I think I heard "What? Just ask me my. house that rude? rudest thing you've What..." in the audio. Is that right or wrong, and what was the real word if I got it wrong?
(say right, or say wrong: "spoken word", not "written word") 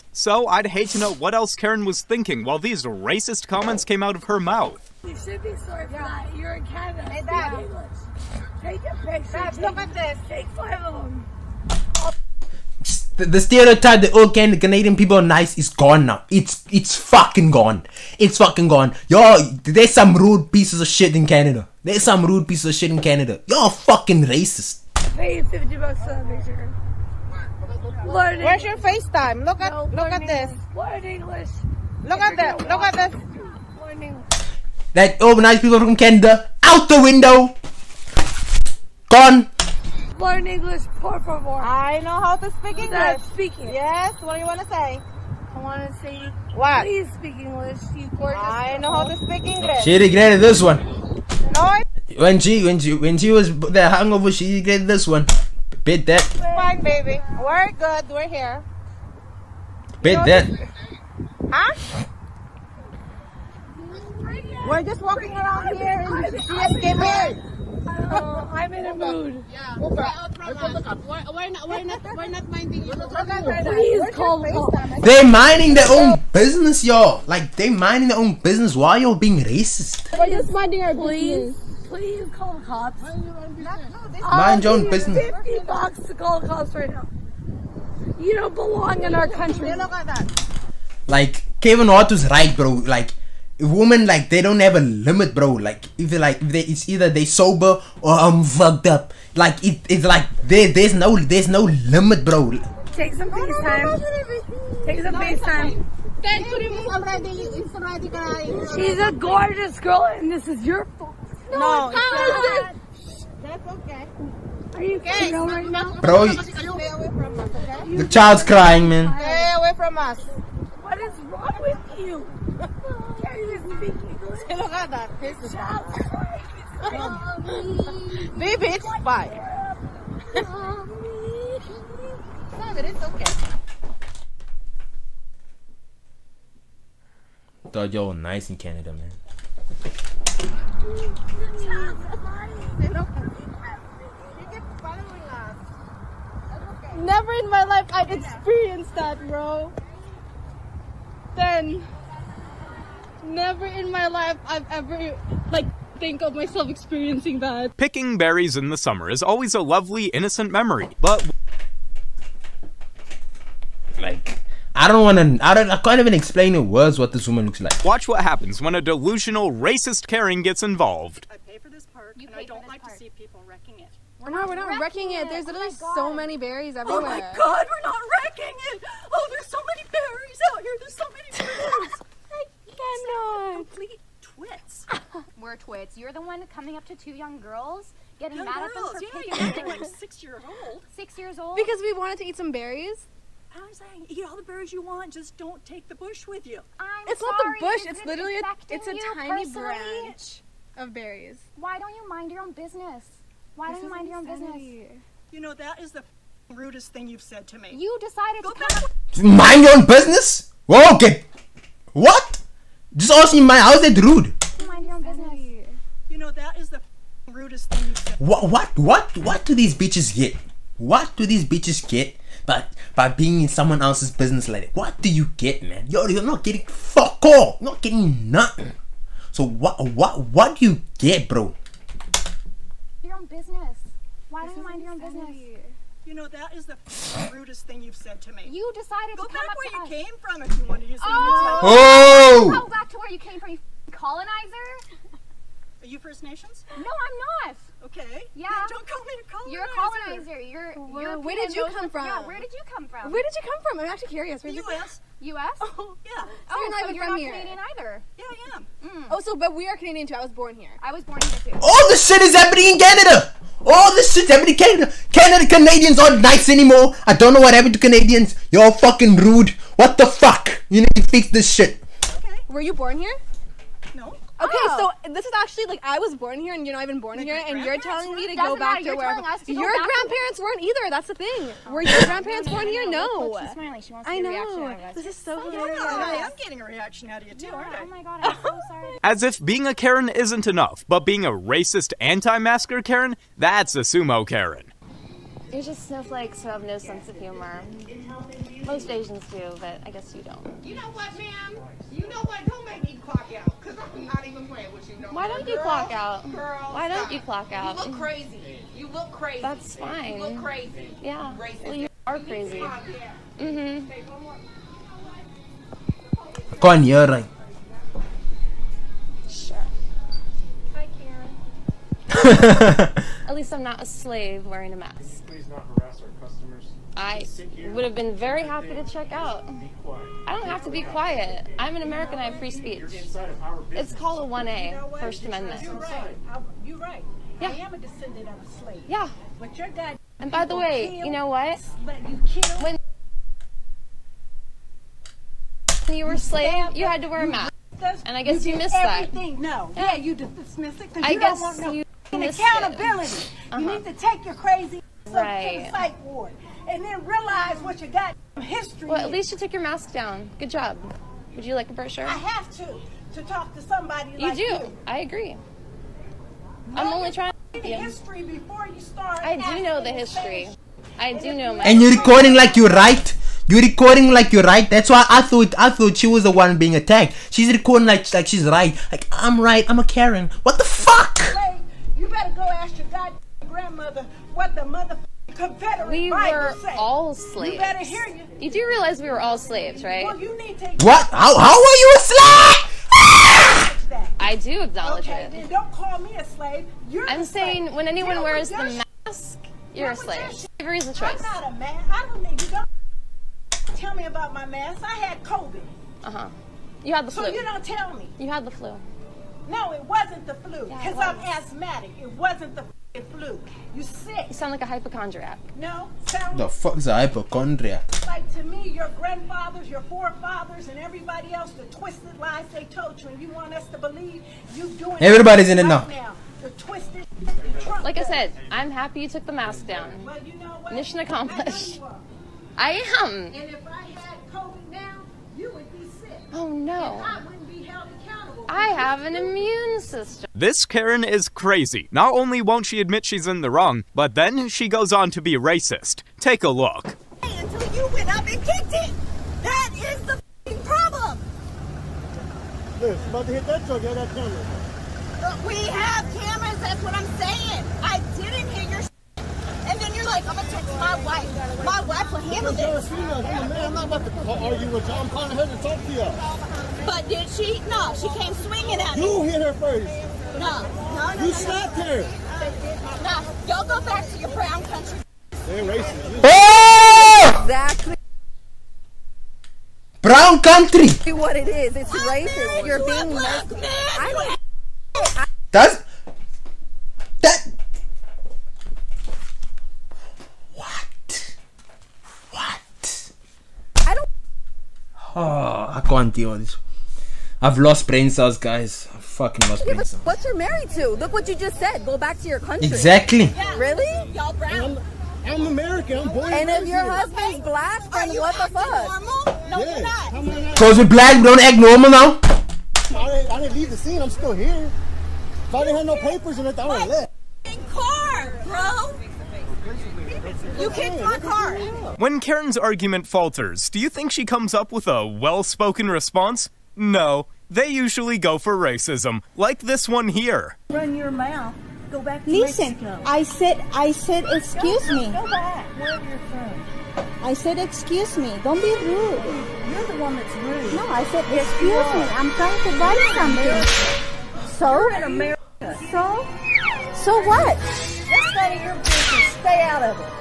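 right.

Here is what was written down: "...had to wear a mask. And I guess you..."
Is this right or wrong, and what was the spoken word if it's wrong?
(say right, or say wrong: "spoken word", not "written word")
right.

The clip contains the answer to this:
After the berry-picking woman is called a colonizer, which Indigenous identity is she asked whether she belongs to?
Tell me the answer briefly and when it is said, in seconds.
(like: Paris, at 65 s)
First Nations, at 245 s.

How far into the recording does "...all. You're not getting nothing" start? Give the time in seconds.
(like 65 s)
227 s.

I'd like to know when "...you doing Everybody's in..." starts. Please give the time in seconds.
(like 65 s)
424 s.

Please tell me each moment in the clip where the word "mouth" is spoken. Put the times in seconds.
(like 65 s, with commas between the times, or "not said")
4 s, 531 s.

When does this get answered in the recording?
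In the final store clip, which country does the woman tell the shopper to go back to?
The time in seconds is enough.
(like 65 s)
532 s.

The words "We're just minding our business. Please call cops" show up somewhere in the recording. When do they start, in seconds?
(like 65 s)
80 s.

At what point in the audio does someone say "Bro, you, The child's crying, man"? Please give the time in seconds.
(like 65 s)
115 s.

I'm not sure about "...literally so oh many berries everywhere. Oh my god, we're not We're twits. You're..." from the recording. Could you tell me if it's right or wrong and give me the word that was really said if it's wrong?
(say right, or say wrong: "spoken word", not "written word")
right.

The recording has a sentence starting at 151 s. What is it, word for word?
Then never in my life I've ever like think of myself experiencing that.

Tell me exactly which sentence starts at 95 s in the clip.
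Like if like if they, it's either they sober or I'm fucked up.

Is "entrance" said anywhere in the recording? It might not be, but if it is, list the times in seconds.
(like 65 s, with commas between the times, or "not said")
not said.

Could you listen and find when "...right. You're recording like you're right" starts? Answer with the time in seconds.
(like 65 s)
372 s.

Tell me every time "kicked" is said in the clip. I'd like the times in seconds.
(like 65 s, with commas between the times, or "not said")
448 s, 520 s.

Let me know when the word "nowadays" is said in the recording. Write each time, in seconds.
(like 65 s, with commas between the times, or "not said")
not said.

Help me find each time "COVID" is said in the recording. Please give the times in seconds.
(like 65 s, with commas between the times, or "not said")
405 s, 434 s.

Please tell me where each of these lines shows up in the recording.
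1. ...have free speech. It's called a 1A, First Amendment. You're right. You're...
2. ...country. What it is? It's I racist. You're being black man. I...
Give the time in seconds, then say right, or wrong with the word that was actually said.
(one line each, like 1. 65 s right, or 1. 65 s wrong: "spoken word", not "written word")
1. 332 s right
2. 480 s right.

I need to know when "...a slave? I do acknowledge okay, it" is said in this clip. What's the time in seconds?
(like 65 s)
391 s.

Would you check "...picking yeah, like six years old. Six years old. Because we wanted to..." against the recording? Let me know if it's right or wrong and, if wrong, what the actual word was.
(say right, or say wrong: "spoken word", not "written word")
right.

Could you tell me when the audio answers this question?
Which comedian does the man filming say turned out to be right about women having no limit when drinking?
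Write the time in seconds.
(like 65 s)
91 s.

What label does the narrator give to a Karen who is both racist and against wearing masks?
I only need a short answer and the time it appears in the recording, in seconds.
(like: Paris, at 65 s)
sumo Karen, at 293 s.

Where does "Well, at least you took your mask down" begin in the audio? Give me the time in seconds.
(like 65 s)
358 s.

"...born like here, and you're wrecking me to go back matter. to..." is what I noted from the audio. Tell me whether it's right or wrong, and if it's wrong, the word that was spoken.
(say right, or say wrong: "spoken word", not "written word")
wrong: "telling", not "wrecking".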